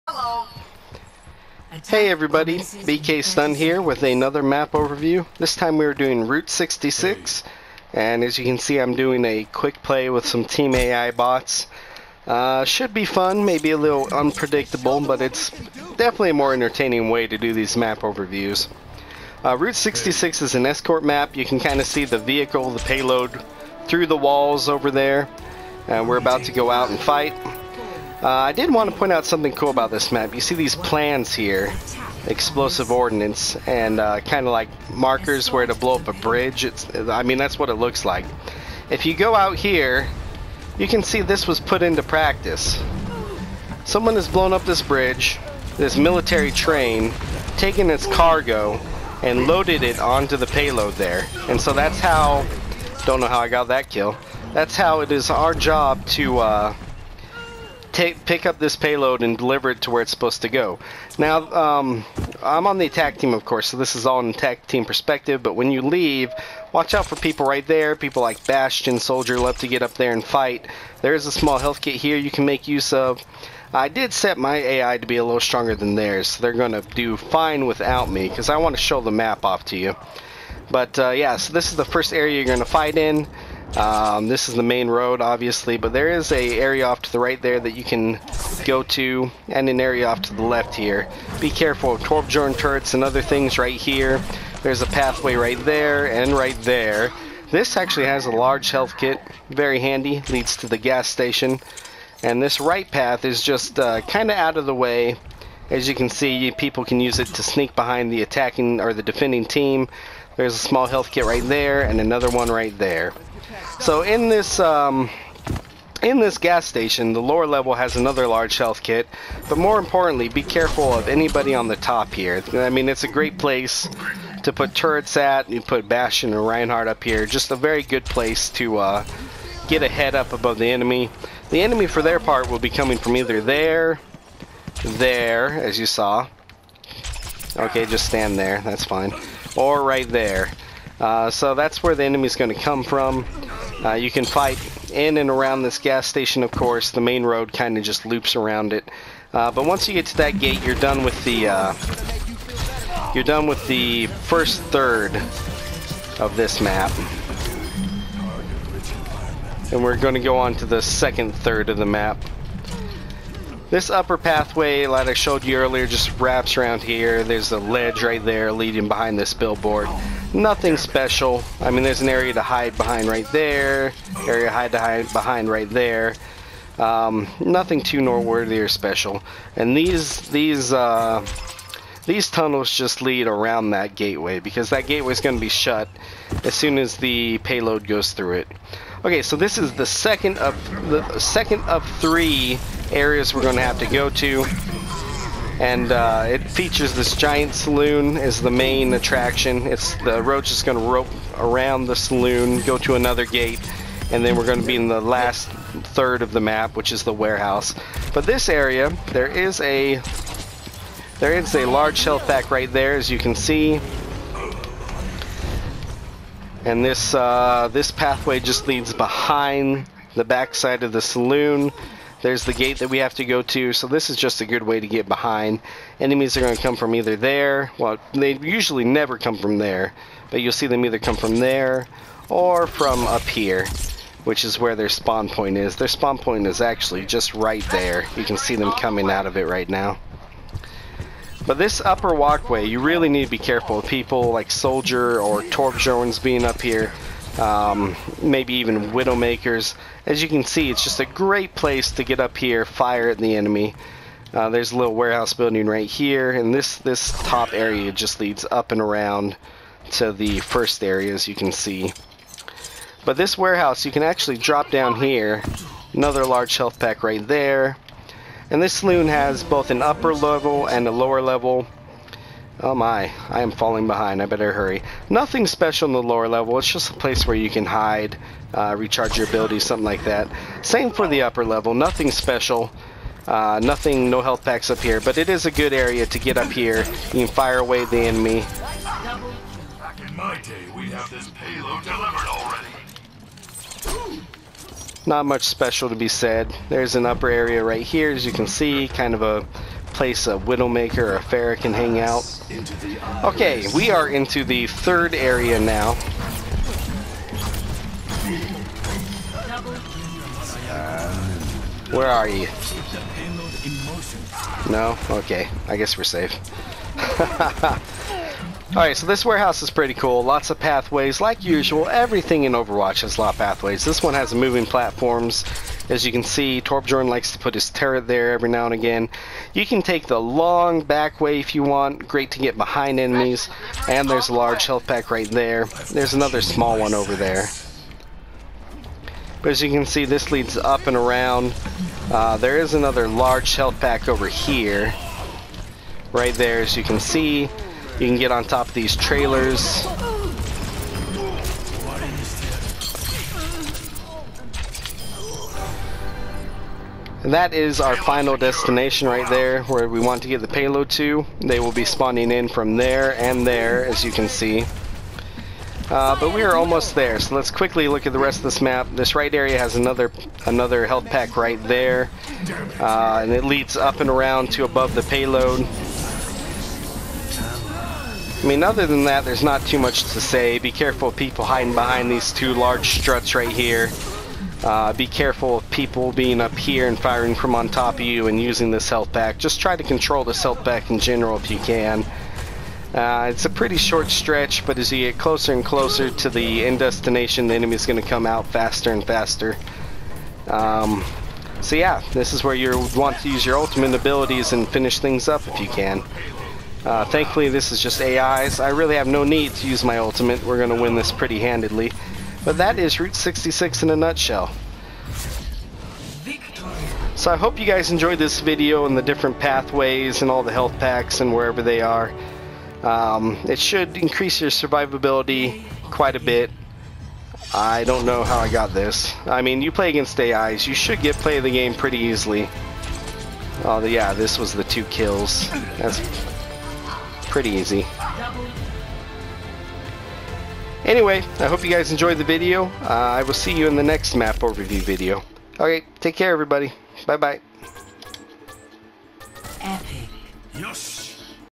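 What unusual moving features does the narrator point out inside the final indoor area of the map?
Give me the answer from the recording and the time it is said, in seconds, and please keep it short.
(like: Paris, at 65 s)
Moving platforms, at 324 s.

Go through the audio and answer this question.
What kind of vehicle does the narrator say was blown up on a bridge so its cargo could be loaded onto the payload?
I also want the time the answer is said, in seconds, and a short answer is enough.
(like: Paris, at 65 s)
Military train, at 45 s.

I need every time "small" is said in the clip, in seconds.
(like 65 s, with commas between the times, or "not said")
71 s, 110 s, 336 s.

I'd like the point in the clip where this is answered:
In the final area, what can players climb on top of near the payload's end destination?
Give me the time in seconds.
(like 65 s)
348 s.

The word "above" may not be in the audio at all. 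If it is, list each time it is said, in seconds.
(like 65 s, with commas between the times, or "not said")
130 s, 374 s.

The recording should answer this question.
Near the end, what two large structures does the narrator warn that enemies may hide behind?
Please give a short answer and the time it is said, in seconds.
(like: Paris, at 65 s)
Two large struts, at 382 s.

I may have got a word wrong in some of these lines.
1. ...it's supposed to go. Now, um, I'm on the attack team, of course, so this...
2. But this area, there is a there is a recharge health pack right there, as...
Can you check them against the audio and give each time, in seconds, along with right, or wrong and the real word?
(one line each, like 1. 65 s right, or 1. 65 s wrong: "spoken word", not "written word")
1. 60 s right
2. 208 s wrong: "large", not "recharge".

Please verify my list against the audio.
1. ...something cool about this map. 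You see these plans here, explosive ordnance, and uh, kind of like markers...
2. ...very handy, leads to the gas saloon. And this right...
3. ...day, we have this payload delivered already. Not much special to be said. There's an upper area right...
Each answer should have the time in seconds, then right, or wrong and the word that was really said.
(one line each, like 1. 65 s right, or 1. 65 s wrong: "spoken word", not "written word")
1. 29 s right
2. 99 s wrong: "station", not "saloon"
3. 290 s right.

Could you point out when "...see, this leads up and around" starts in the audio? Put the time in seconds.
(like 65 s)
339 s.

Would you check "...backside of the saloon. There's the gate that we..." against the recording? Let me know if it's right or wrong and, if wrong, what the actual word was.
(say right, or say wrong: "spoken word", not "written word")
right.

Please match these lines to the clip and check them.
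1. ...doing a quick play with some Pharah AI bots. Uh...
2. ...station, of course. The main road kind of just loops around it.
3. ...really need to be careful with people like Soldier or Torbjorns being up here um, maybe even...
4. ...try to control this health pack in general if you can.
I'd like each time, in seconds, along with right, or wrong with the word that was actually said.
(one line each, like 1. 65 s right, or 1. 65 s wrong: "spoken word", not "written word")
1. 8 s wrong: "Team", not "Pharah"
2. 146 s right
3. 242 s right
4. 389 s right.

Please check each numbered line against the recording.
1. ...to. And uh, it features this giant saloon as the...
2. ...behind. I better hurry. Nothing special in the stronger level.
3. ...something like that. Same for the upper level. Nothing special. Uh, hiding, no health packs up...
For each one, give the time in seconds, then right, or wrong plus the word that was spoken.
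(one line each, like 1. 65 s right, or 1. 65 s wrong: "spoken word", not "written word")
1. 194 s right
2. 273 s wrong: "lower", not "stronger"
3. 279 s wrong: "nothing", not "hiding".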